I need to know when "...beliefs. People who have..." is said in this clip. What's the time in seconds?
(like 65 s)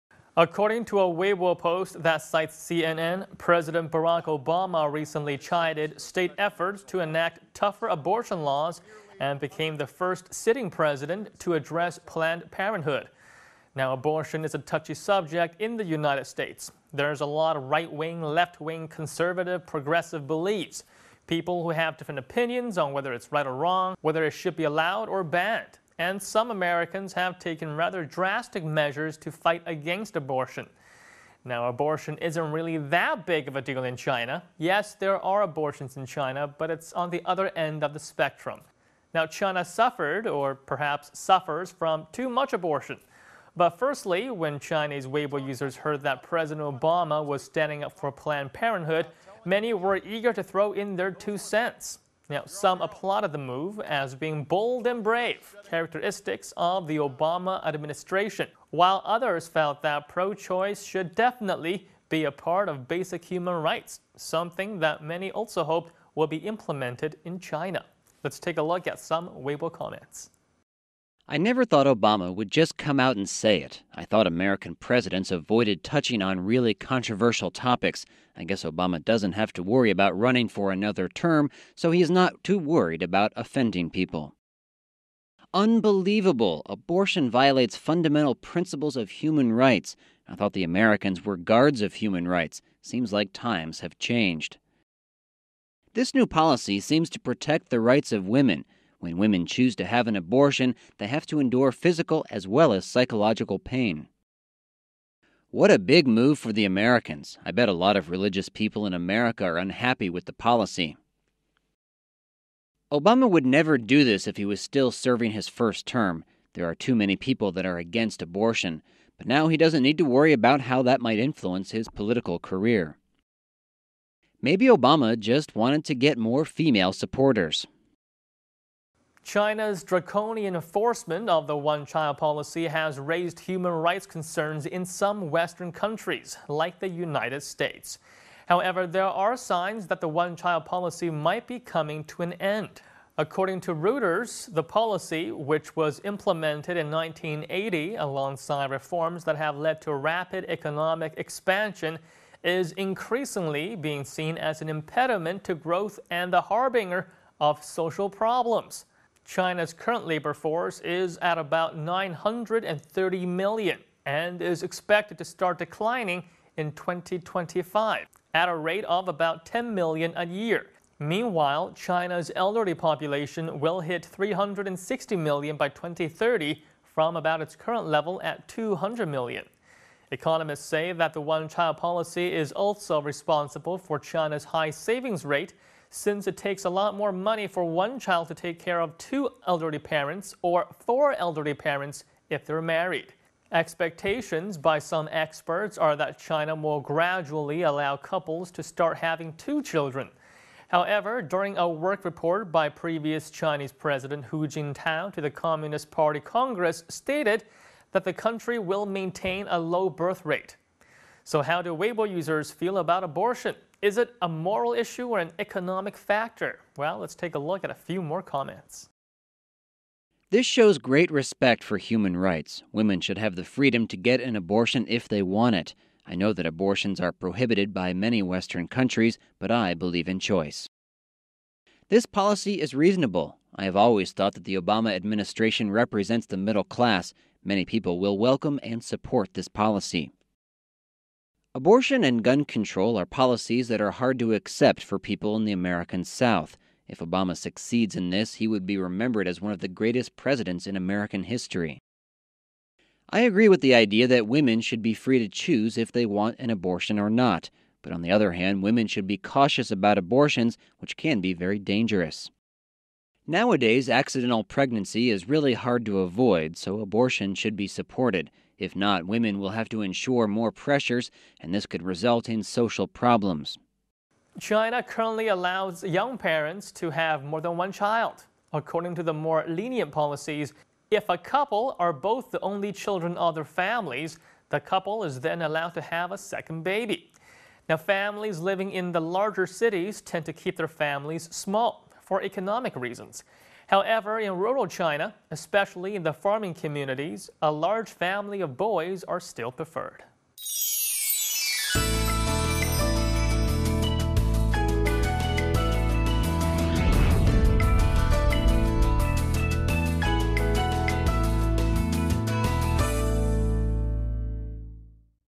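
20 s.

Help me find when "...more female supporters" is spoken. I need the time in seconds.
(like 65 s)
126 s.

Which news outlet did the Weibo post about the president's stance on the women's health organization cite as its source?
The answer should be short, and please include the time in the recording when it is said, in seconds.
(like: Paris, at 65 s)
CNN, at 2 s.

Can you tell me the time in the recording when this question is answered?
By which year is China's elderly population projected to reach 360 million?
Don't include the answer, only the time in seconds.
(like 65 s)
175 s.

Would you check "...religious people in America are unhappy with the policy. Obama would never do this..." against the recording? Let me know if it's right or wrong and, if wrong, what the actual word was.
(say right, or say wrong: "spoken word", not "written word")
right.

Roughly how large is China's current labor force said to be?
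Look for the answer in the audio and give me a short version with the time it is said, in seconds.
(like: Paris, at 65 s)
930 million, at 161 s.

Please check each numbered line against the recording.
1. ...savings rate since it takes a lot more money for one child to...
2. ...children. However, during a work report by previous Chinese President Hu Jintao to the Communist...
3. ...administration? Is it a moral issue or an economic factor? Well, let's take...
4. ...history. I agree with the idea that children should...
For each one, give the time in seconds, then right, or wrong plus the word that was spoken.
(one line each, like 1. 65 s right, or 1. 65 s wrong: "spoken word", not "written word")
1. 184 s right
2. 199 s right
3. 213 s wrong: "abortion", not "administration"
4. 251 s wrong: "women", not "children".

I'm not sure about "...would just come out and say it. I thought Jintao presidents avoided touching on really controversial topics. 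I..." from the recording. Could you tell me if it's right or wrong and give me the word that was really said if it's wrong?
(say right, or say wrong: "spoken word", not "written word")
wrong: "American", not "Jintao".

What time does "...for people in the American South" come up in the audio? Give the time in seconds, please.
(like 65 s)
244 s.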